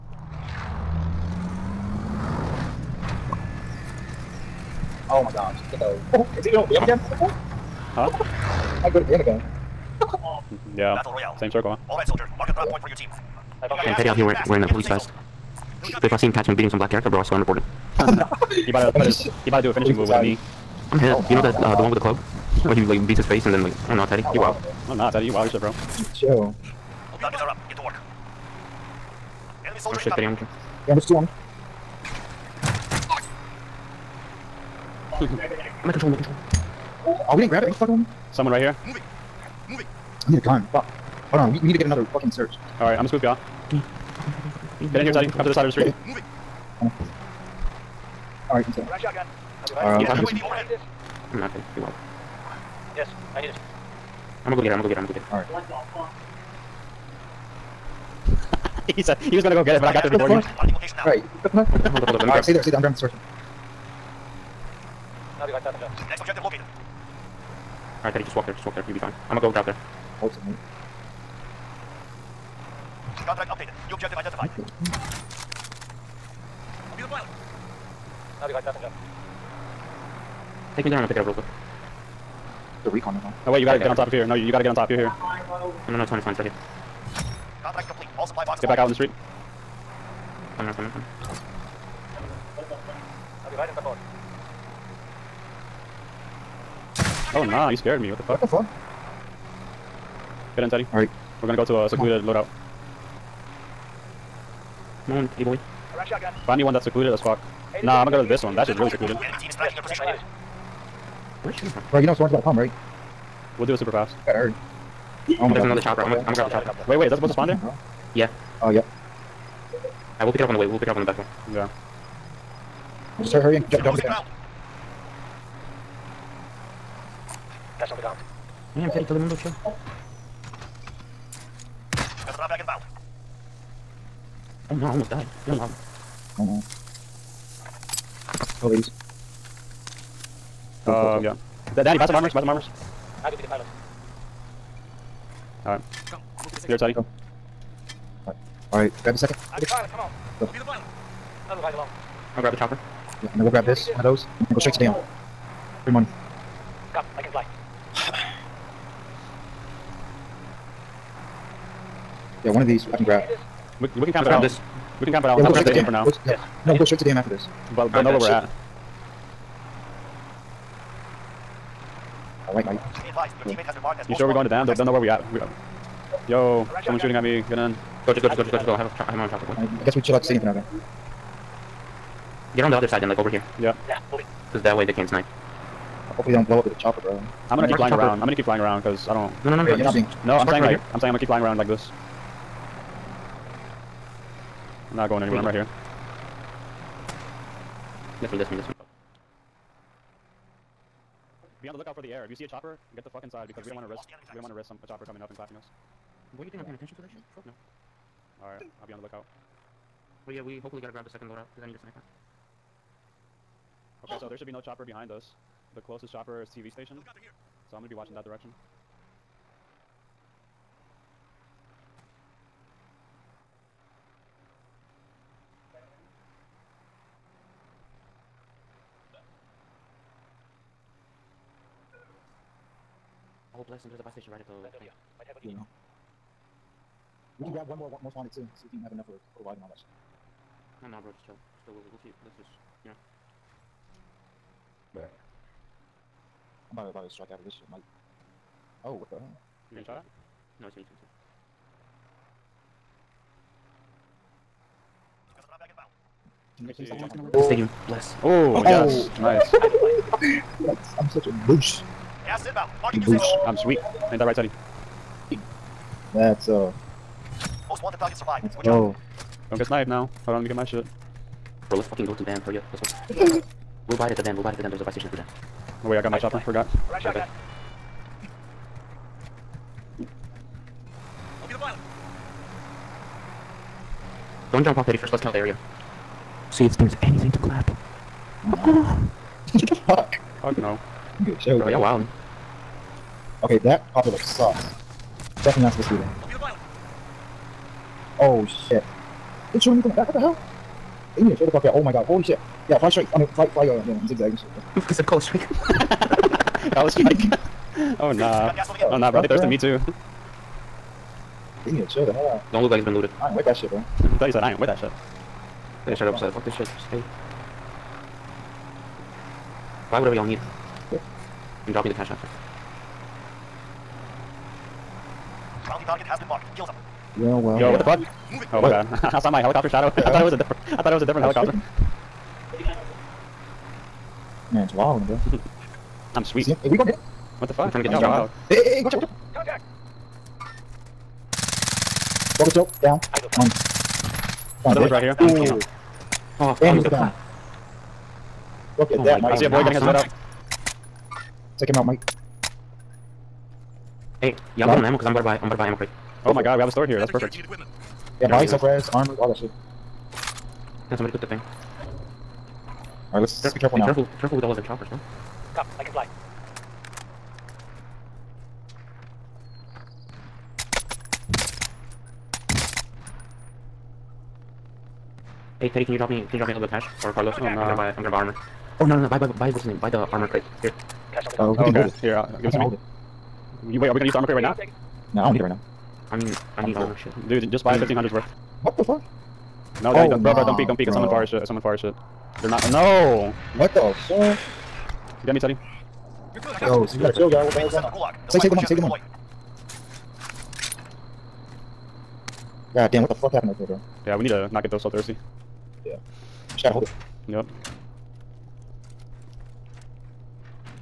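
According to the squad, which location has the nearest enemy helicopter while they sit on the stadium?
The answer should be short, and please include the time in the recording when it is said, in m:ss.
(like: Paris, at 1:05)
TV station, at 3:36.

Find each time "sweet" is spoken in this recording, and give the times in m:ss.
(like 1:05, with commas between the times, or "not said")
4:23, 5:36.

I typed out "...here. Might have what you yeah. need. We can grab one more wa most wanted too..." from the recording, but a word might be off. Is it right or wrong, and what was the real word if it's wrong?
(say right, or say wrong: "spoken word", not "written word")
right.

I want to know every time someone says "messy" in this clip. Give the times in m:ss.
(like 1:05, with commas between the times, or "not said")
not said.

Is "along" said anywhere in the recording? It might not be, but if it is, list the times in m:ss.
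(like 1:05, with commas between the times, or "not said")
2:31.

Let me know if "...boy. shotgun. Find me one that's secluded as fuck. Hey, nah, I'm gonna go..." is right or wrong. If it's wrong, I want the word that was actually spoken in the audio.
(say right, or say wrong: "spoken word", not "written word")
right.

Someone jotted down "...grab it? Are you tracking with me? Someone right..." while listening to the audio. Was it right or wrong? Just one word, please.
wrong.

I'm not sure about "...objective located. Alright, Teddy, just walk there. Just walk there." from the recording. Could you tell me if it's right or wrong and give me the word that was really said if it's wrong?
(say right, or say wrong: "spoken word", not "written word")
right.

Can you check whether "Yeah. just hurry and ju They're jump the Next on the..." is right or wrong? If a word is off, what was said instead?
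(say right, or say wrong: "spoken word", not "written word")
wrong: "Cash", not "Next".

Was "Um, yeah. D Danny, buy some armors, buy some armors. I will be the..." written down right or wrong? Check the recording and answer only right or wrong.
right.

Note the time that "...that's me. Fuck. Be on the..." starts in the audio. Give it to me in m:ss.
3:18.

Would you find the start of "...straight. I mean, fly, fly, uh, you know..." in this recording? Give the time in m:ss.
5:02.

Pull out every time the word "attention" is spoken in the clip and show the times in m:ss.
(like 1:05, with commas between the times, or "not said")
3:26.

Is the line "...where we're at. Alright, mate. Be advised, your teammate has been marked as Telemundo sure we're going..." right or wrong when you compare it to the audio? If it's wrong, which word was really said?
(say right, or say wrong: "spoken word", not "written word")
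wrong: "You", not "Telemundo".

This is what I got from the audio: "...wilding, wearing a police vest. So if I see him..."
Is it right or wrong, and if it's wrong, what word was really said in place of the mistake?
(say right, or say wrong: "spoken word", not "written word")
wrong: "wearing", not "wilding".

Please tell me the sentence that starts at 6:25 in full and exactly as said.
No, I don't need it right now.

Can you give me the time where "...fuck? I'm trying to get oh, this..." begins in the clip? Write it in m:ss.
5:37.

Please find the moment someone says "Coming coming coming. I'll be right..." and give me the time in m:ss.
1:30.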